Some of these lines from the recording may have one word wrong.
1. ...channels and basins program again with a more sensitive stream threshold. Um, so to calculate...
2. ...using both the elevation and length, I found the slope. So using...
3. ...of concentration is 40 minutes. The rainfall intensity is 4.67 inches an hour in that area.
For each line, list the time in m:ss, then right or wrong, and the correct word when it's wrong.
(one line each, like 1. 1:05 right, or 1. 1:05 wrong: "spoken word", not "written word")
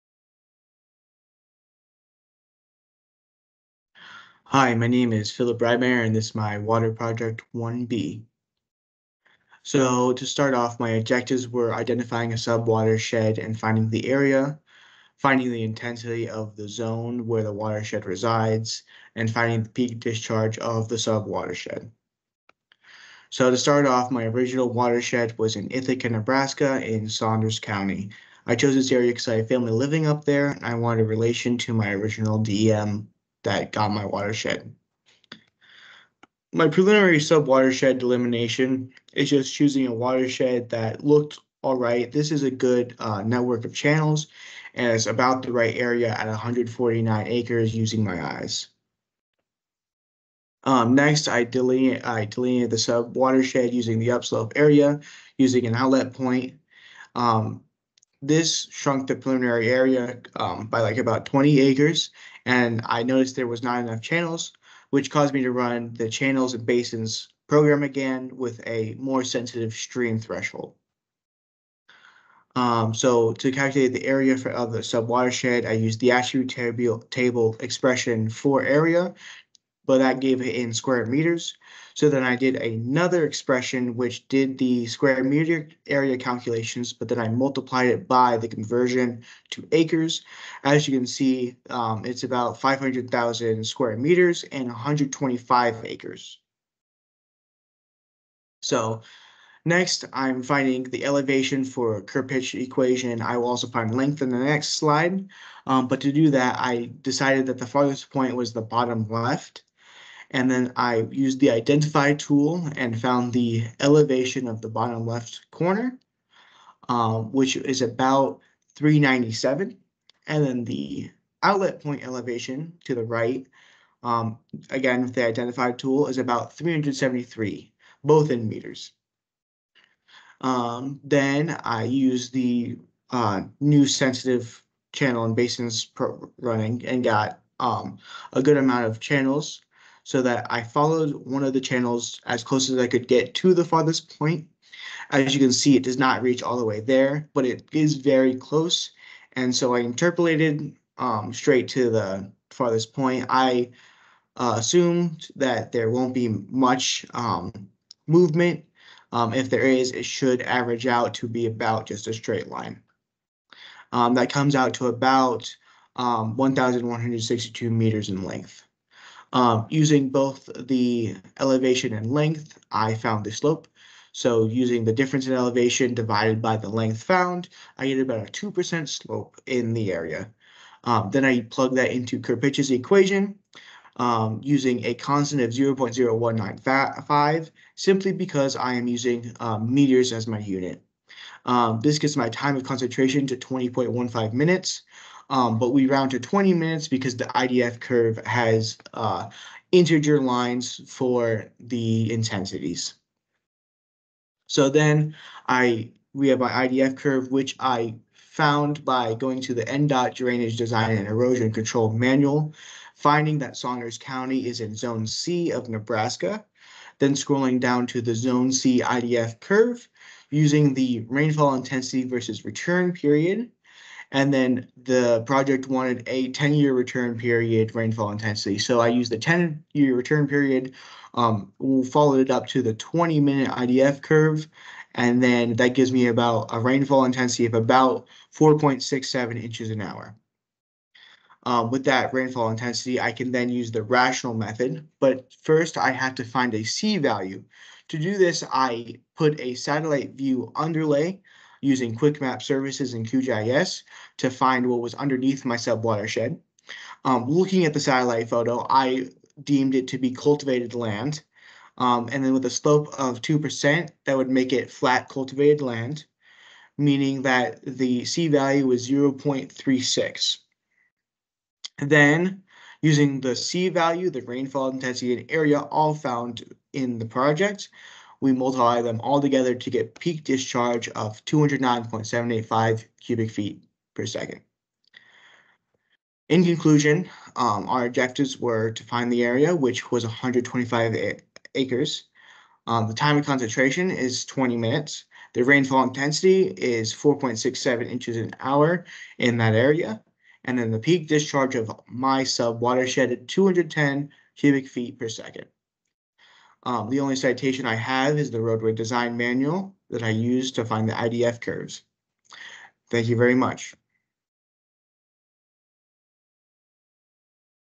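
1. 1:06 right
2. 2:49 right
3. 4:53 wrong: "20", not "40".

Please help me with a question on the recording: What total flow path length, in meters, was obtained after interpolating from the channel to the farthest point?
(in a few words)
1,162 meters.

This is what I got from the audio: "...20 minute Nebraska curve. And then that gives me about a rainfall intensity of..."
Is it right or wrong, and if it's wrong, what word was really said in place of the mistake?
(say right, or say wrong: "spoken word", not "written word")
wrong: "IDF", not "Nebraska".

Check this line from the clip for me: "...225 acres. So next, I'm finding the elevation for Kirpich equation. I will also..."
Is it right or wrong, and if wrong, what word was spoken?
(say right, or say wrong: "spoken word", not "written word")
wrong: "125", not "225".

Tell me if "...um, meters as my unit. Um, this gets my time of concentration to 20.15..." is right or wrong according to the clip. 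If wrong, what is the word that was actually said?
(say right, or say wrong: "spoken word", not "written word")
right.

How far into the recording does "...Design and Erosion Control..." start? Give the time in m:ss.
3:30.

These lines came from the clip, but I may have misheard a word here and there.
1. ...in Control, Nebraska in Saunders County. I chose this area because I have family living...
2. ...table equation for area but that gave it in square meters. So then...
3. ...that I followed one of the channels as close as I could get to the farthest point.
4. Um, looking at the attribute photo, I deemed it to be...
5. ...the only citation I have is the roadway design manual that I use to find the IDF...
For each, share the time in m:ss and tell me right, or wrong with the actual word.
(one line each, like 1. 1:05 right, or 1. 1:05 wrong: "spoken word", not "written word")
1. 0:25 wrong: "Ithaca", not "Control"
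2. 1:17 wrong: "expression", not "equation"
3. 2:20 right
4. 4:17 wrong: "satellite", not "attribute"
5. 5:06 right.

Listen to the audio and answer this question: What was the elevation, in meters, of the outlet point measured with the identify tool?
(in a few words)
373.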